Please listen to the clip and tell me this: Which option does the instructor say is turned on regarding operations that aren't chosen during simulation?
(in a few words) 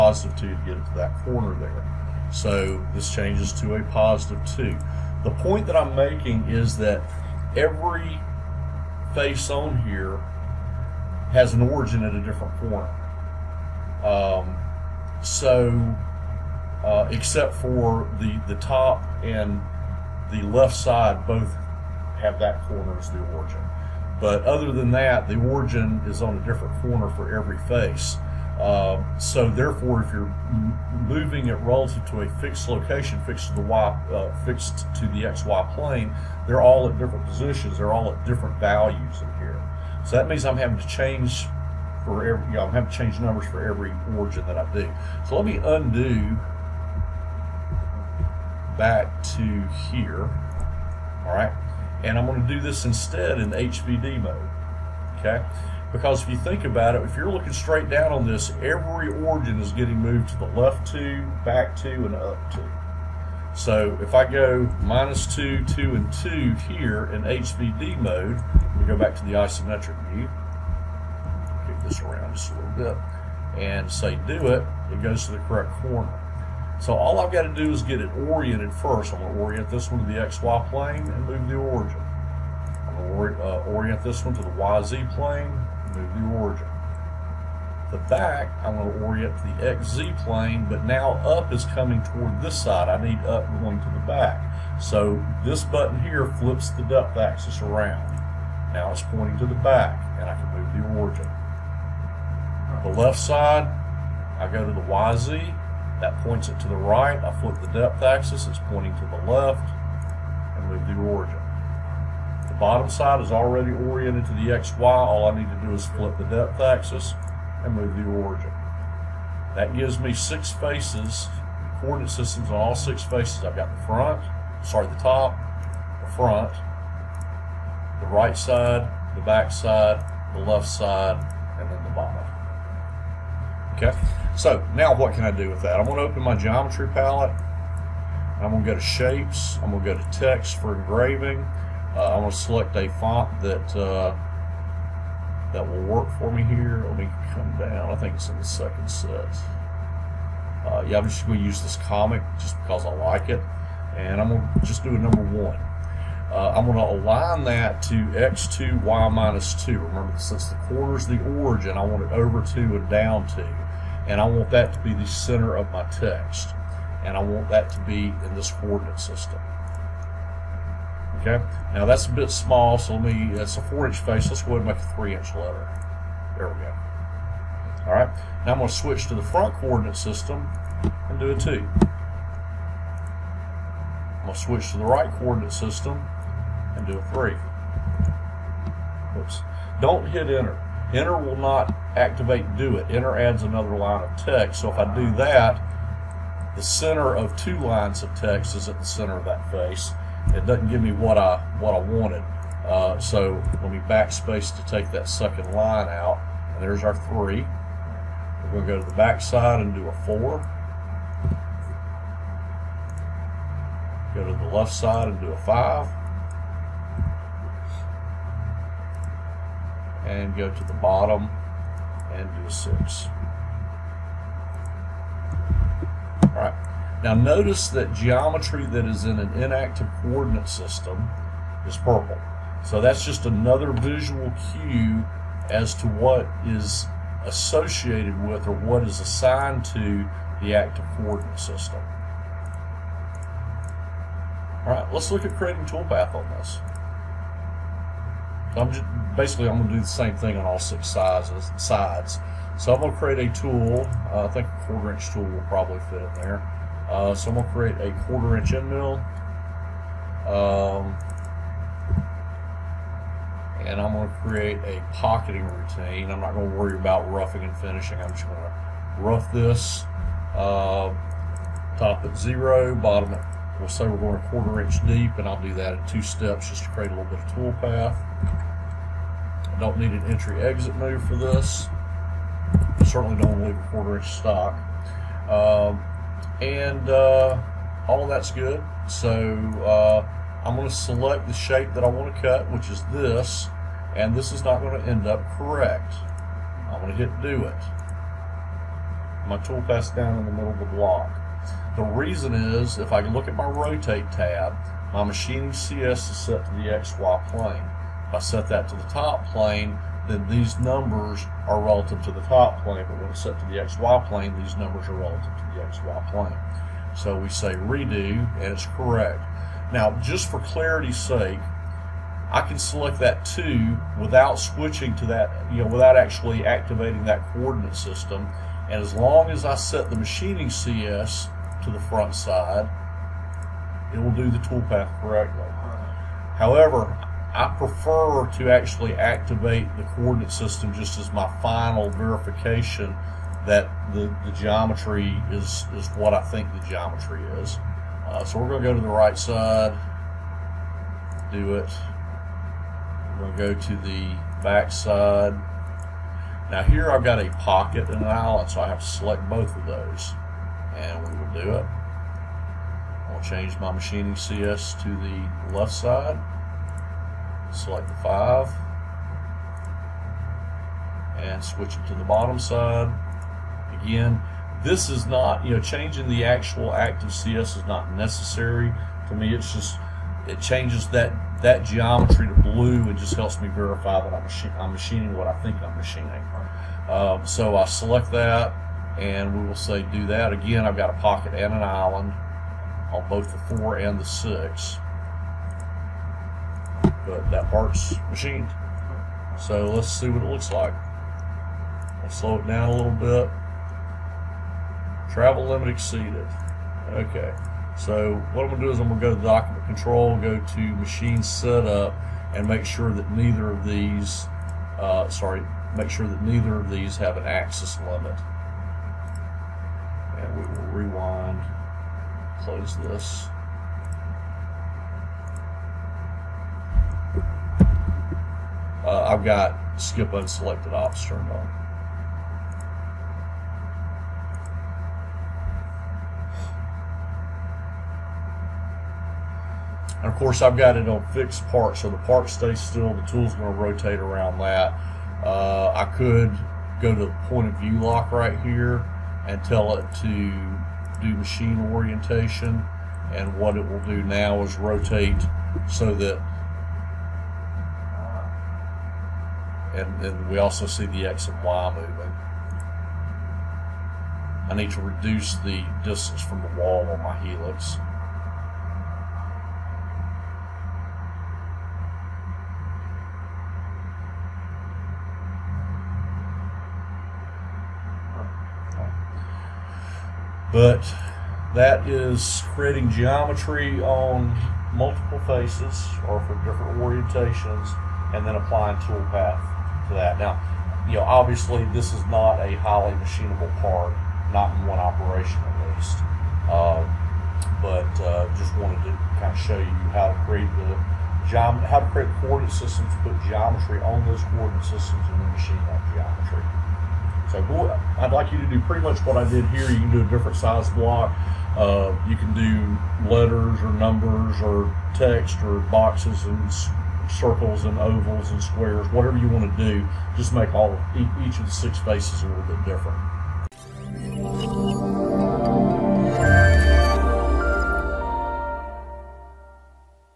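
Skip unselected ops.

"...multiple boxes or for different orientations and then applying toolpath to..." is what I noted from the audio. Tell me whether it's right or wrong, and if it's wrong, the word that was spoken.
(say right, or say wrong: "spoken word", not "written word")
wrong: "faces", not "boxes".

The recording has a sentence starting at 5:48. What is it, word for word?
Uh, so we're going to go to the right side, do it.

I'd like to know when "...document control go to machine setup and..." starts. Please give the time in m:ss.
6:49.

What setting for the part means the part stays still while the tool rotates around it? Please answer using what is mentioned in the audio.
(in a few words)
Fixed park.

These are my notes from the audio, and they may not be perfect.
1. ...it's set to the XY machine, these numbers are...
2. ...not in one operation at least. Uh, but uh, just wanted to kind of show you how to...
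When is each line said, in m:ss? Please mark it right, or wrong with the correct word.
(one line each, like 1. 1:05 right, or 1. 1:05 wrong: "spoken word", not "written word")
1. 5:13 wrong: "plane", not "machine"
2. 8:14 right.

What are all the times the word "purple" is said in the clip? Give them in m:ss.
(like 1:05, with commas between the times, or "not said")
3:51.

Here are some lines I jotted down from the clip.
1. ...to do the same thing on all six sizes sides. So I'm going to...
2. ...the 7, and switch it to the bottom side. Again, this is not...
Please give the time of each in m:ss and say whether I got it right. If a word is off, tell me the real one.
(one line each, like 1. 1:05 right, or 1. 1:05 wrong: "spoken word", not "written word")
1. 4:09 right
2. 6:07 wrong: "5", not "7".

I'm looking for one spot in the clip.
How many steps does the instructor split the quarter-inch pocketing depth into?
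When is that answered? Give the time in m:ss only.
4:35.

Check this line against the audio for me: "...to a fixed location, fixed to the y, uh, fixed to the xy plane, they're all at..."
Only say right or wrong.
right.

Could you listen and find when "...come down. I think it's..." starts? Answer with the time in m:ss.
2:27.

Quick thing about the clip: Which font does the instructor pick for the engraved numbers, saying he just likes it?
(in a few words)
Comic.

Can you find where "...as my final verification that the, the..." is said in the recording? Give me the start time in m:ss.
5:40.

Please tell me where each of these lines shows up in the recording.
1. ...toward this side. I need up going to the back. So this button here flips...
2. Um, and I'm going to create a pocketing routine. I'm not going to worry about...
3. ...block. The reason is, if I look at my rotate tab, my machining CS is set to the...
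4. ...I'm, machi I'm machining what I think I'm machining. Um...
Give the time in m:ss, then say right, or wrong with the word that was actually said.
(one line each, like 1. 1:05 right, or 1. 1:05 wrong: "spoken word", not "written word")
1. 1:32 right
2. 4:20 right
3. 5:00 right
4. 6:24 right.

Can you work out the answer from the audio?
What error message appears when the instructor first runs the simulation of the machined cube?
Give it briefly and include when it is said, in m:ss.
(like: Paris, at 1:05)
Travel limit exceeded, at 6:45.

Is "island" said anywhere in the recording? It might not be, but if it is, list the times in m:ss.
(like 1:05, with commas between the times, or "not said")
5:58, 6:31.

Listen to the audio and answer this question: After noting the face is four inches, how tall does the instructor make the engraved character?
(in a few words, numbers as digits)
3 inch.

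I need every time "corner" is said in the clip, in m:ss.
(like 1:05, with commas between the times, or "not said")
0:01, 0:12, 0:22, 0:26, 1:15.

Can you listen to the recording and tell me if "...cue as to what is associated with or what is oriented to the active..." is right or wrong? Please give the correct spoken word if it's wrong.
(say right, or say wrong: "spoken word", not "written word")
wrong: "assigned", not "oriented".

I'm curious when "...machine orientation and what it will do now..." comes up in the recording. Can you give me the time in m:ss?
7:31.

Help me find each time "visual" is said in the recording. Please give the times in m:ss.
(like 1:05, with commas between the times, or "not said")
3:53.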